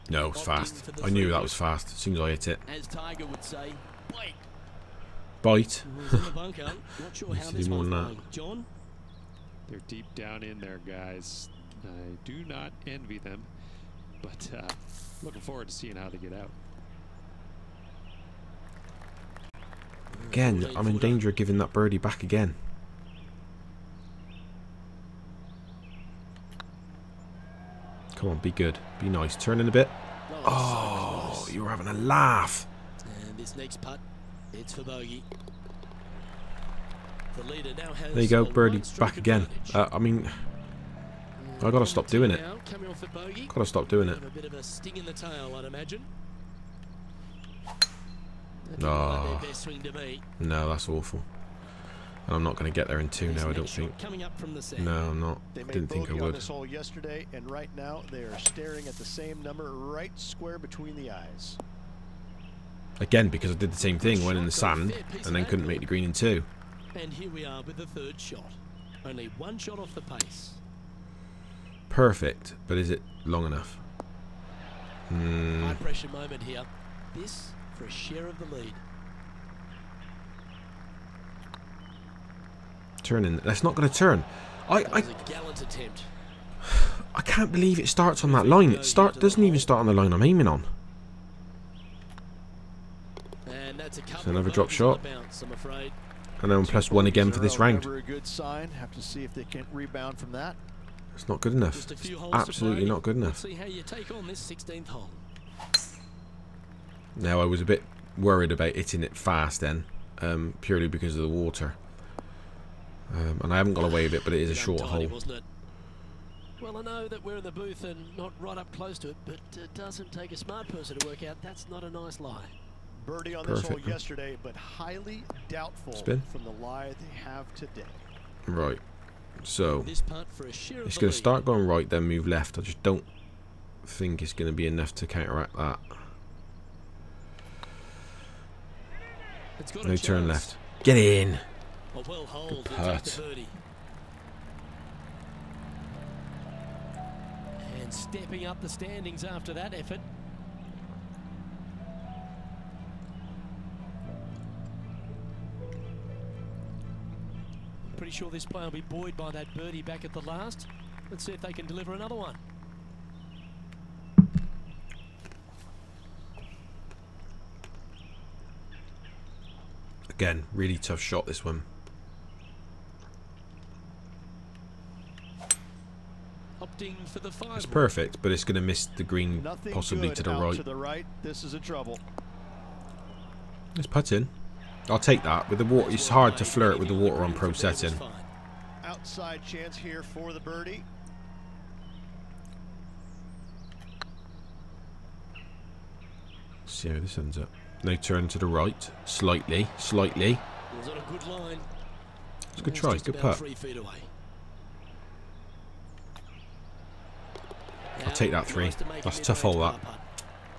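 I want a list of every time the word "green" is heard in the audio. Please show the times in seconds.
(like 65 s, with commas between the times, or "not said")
65 s, 179 s.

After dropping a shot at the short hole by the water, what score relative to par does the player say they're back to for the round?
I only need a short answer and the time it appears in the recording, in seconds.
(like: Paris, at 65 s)
Plus one, at 96 s.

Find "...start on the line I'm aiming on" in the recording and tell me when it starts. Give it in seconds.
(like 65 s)
89 s.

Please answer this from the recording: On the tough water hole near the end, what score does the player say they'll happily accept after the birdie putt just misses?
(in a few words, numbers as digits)
3.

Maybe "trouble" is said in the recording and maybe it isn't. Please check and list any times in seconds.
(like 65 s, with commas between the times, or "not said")
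181 s.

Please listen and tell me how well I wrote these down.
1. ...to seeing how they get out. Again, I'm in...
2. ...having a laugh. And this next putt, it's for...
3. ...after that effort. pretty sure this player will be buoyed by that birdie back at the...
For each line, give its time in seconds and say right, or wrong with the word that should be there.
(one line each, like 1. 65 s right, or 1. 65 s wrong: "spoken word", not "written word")
1. 15 s right
2. 31 s right
3. 149 s right.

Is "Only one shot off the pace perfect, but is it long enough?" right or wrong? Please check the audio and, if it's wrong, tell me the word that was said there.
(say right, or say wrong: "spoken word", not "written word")
right.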